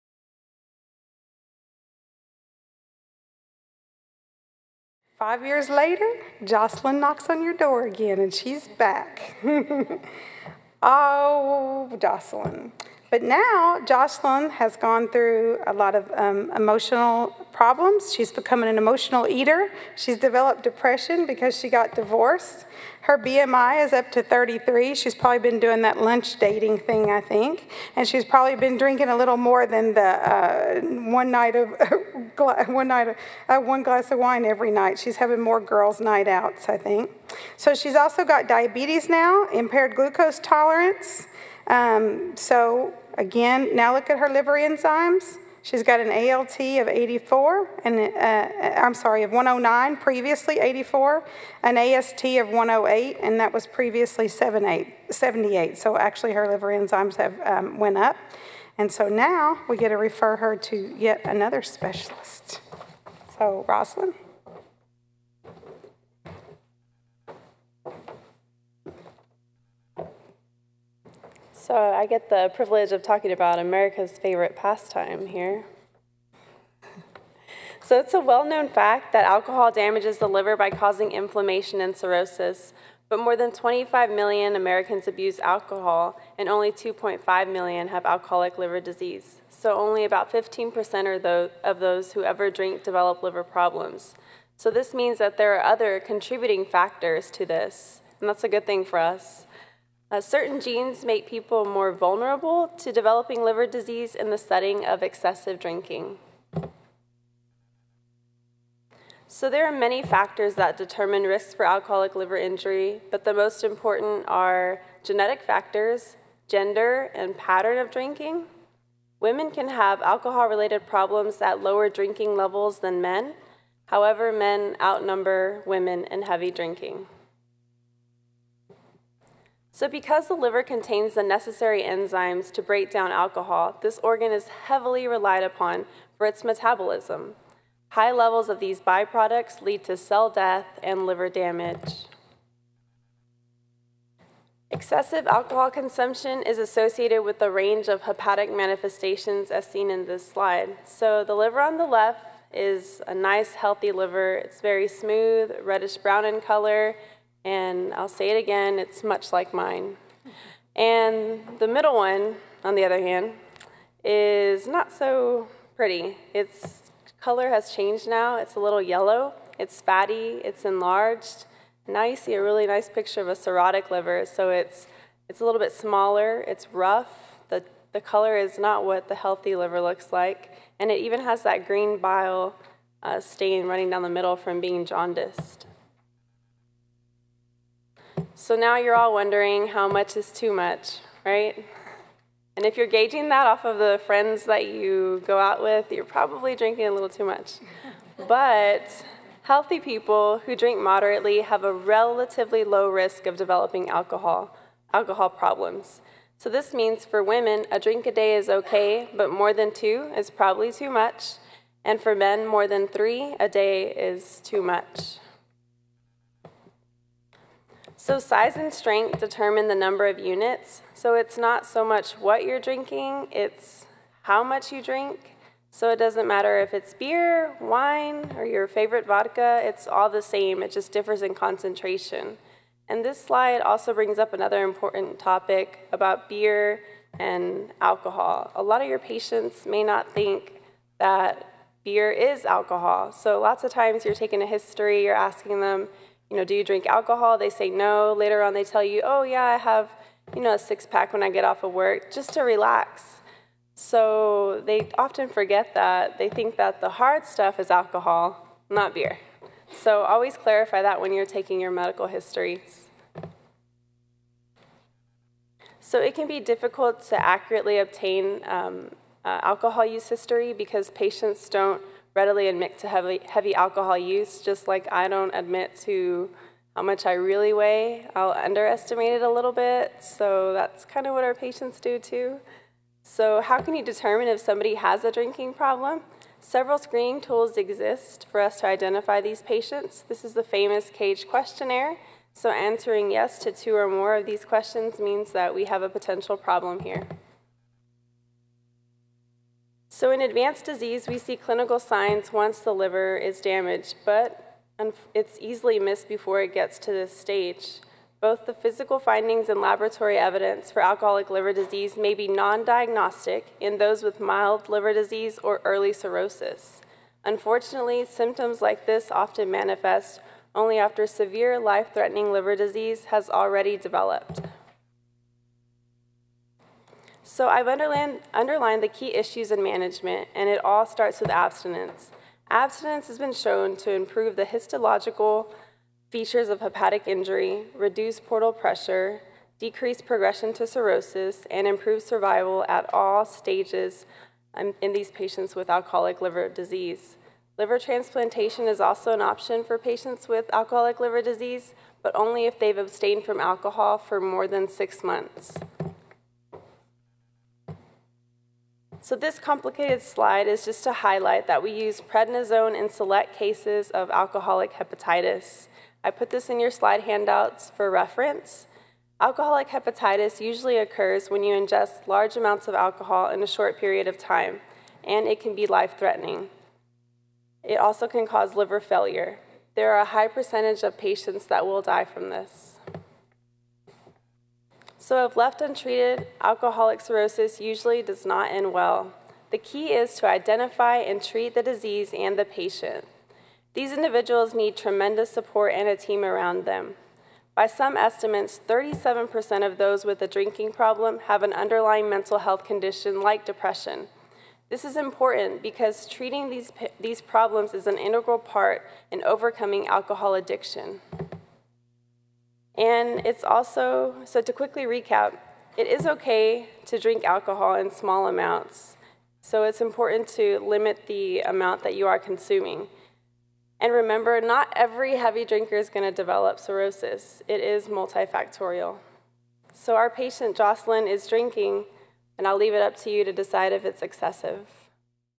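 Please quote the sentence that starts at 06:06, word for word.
I put this in your slide handouts for reference.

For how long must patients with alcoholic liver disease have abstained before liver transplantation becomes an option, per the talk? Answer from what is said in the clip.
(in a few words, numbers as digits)
6 months.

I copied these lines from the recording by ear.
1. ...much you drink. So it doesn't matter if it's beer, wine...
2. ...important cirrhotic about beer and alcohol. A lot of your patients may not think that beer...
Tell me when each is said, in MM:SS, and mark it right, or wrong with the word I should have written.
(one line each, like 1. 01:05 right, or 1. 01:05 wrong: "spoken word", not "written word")
1. 03:44 right
2. 03:54 wrong: "topic", not "cirrhotic".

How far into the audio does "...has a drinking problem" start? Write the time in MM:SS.
04:44.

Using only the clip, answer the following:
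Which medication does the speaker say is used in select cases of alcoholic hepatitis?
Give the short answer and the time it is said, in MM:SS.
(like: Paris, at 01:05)
prednisone, at 06:02.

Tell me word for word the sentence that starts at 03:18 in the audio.
but healthy people who drink moderately have a relatively low risk of developing alcohol, alcohol problems.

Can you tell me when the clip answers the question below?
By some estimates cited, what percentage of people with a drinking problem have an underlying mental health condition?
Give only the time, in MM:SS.
06:38.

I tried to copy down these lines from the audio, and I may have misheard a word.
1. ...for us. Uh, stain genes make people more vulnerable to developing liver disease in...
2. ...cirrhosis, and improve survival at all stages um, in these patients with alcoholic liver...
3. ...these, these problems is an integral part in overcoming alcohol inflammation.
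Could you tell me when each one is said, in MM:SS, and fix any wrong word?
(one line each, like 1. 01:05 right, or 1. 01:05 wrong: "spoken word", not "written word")
1. 01:38 wrong: "certain", not "stain"
2. 05:40 right
3. 06:46 wrong: "addiction", not "inflammation".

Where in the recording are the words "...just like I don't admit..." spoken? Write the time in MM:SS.
04:34.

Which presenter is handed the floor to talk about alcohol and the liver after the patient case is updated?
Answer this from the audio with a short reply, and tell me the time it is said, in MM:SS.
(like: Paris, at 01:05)
Rossalynn, at 01:03.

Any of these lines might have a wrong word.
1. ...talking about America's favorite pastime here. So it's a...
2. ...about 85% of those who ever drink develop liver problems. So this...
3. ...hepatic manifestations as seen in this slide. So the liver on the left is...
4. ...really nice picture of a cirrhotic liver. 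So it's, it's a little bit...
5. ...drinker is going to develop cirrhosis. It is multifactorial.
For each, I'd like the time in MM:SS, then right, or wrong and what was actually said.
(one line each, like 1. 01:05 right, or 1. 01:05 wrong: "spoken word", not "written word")
1. 01:13 right
2. 01:30 wrong: "15", not "85"
3. 02:28 right
4. 02:52 right
5. 07:05 right.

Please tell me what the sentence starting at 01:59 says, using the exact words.
Women can have alcohol-related problems at lower drinking levels than men.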